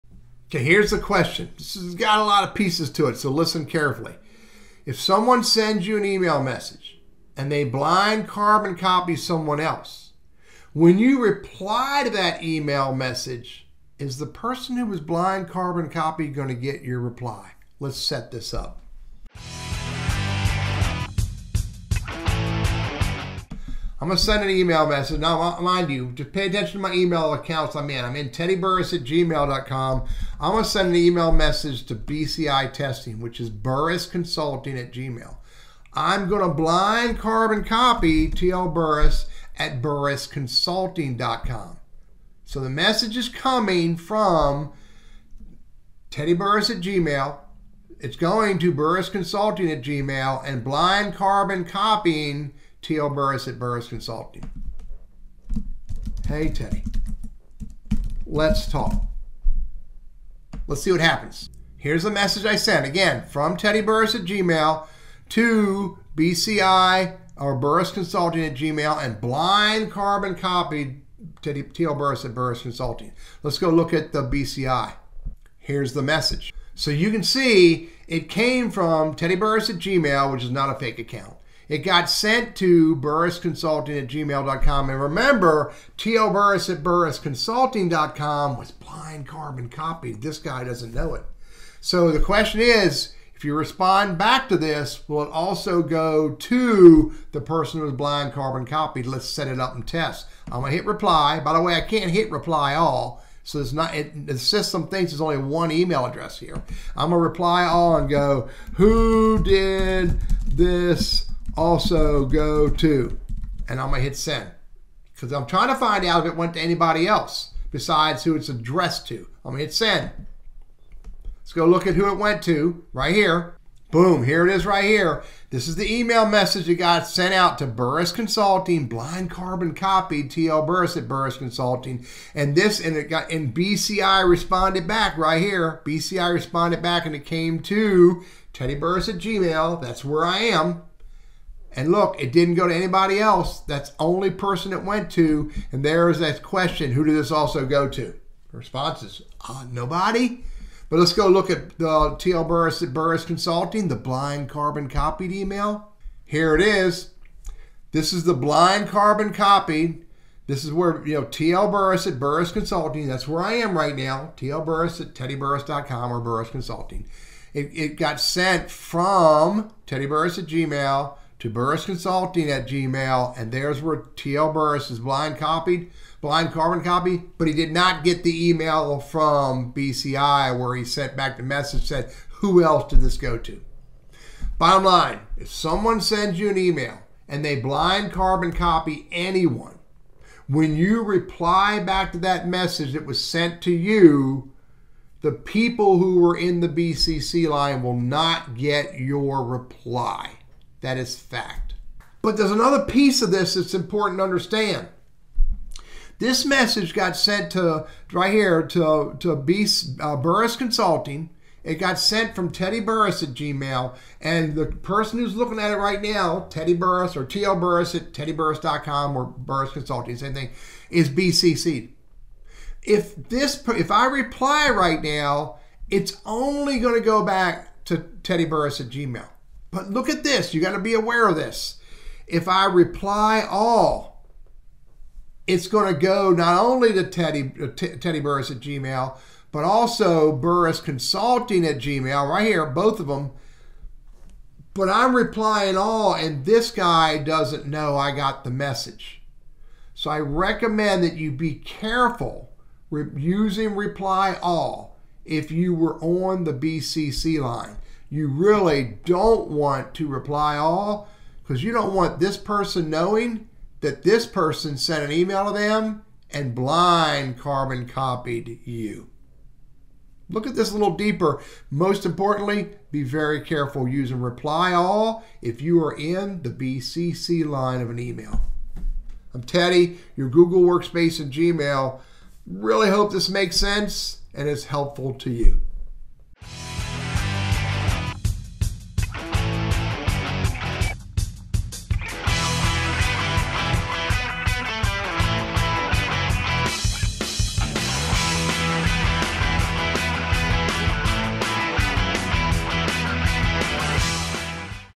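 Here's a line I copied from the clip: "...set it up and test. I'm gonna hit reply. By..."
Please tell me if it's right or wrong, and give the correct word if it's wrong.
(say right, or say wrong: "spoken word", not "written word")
right.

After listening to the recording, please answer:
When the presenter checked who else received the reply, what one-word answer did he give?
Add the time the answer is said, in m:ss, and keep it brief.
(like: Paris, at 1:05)
Nobody, at 2:29.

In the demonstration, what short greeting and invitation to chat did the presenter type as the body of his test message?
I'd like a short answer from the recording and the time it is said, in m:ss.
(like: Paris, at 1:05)
Hey, Teddy. Let's talk., at 0:56.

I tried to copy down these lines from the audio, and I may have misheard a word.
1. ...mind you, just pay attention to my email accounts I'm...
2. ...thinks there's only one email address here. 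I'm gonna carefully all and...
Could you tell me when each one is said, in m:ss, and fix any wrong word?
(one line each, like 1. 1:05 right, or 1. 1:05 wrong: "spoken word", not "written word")
1. 0:25 right
2. 1:44 wrong: "reply", not "carefully".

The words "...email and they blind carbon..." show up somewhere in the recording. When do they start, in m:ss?
3:06.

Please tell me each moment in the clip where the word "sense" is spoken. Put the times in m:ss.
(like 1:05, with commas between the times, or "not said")
4:43.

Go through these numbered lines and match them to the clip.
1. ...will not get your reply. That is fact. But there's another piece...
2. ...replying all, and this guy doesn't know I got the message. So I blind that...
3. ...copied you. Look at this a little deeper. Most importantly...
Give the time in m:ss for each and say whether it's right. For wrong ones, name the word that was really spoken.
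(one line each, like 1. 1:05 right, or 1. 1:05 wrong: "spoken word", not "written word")
1. 3:17 right
2. 4:05 wrong: "recommend", not "blind"
3. 4:27 right.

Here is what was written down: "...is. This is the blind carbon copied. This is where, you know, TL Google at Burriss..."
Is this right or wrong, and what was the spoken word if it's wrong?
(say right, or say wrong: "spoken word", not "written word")
wrong: "Burriss", not "Google".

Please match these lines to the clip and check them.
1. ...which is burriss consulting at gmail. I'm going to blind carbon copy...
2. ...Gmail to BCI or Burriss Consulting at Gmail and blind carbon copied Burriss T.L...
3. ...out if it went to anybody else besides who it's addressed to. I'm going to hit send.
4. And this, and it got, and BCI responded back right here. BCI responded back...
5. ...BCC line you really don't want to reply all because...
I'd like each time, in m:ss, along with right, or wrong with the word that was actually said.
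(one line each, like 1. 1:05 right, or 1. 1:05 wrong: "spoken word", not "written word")
1. 0:33 right
2. 1:04 wrong: "Teddy", not "Burriss"
3. 1:56 right
4. 2:12 right
5. 4:16 right.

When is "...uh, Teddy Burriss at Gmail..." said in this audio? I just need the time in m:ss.
3:57.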